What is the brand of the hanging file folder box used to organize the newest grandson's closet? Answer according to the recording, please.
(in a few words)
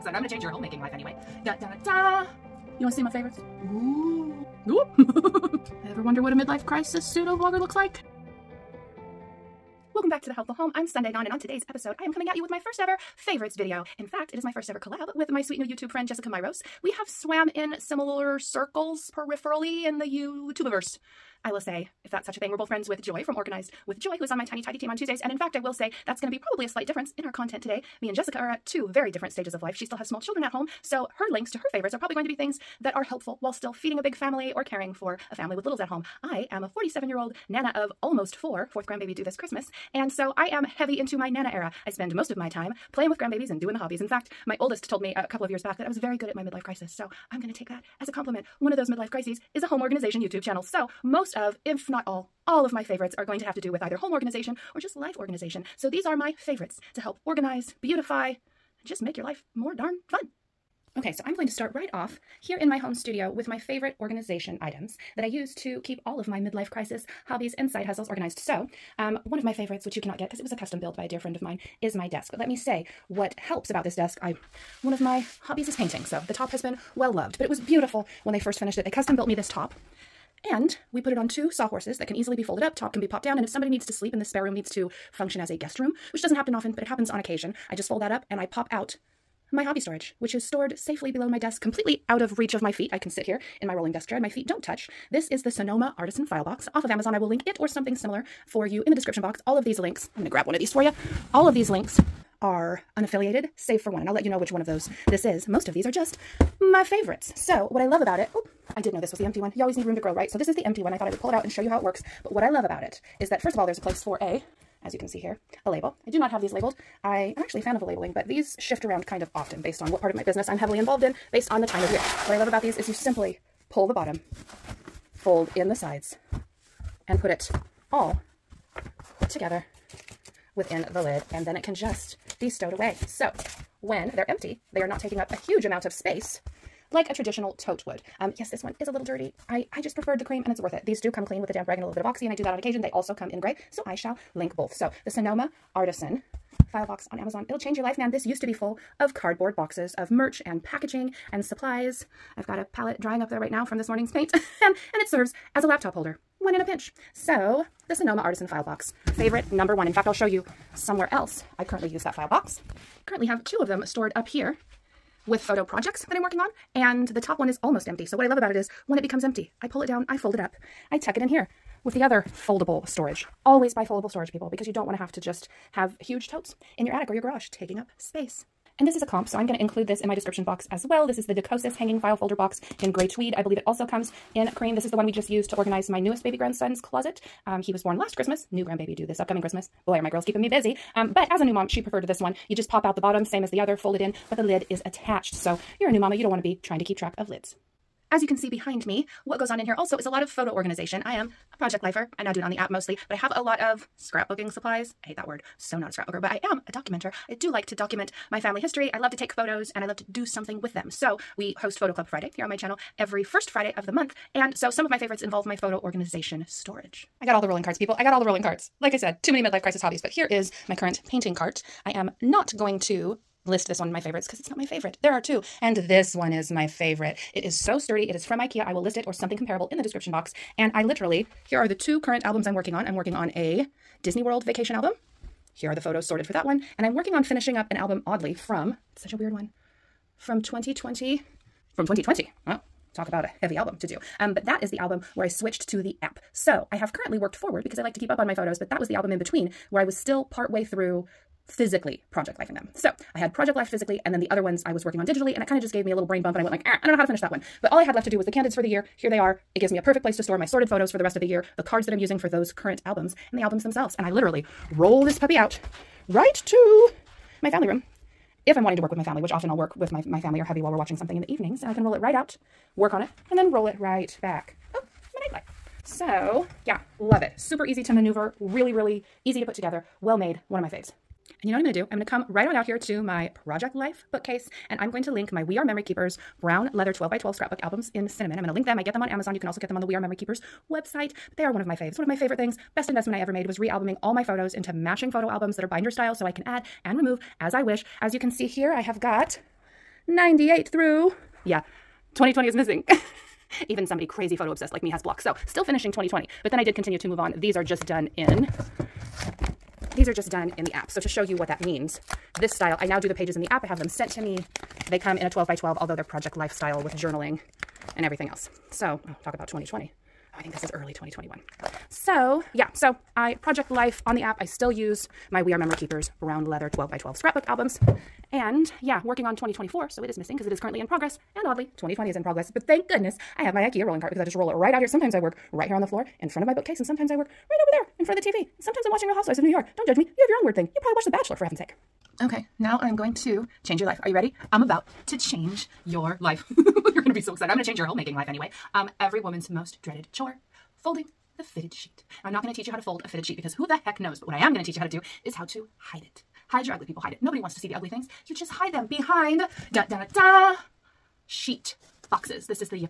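Decosis.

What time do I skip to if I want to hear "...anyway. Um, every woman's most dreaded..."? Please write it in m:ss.
5:48.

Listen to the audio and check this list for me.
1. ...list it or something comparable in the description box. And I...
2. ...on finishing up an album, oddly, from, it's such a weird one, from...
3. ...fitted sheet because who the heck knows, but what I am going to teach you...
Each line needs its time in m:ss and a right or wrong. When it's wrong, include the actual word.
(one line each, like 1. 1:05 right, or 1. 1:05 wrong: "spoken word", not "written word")
1. 3:48 right
2. 3:57 right
3. 5:53 right.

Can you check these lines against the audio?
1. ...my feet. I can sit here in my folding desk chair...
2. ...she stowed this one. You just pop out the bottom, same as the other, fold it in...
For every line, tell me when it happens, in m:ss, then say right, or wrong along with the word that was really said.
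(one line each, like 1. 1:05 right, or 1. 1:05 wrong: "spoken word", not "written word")
1. 1:32 wrong: "rolling", not "folding"
2. 3:11 wrong: "preferred", not "stowed".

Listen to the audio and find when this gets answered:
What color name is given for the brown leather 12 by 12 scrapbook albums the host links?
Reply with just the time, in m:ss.
4:48.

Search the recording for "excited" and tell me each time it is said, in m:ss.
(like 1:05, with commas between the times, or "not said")
5:47.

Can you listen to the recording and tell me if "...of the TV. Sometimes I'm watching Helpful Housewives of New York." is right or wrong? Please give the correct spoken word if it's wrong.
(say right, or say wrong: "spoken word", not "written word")
wrong: "Real", not "Helpful".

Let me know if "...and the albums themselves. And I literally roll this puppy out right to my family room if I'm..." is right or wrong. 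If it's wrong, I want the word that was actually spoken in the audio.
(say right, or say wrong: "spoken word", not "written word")
right.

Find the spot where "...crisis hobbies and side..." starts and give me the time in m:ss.
1:06.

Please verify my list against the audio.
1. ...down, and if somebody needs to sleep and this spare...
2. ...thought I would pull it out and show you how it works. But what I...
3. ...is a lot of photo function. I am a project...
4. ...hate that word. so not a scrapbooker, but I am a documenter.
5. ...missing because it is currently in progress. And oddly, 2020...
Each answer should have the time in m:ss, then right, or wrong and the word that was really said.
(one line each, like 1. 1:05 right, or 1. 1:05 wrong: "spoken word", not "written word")
1. 1:23 right
2. 1:50 right
3. 3:19 wrong: "organization", not "function"
4. 3:25 right
5. 5:30 right.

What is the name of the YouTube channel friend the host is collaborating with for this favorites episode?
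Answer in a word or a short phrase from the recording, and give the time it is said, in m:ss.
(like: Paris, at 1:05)
Jessica Myrose, at 0:16.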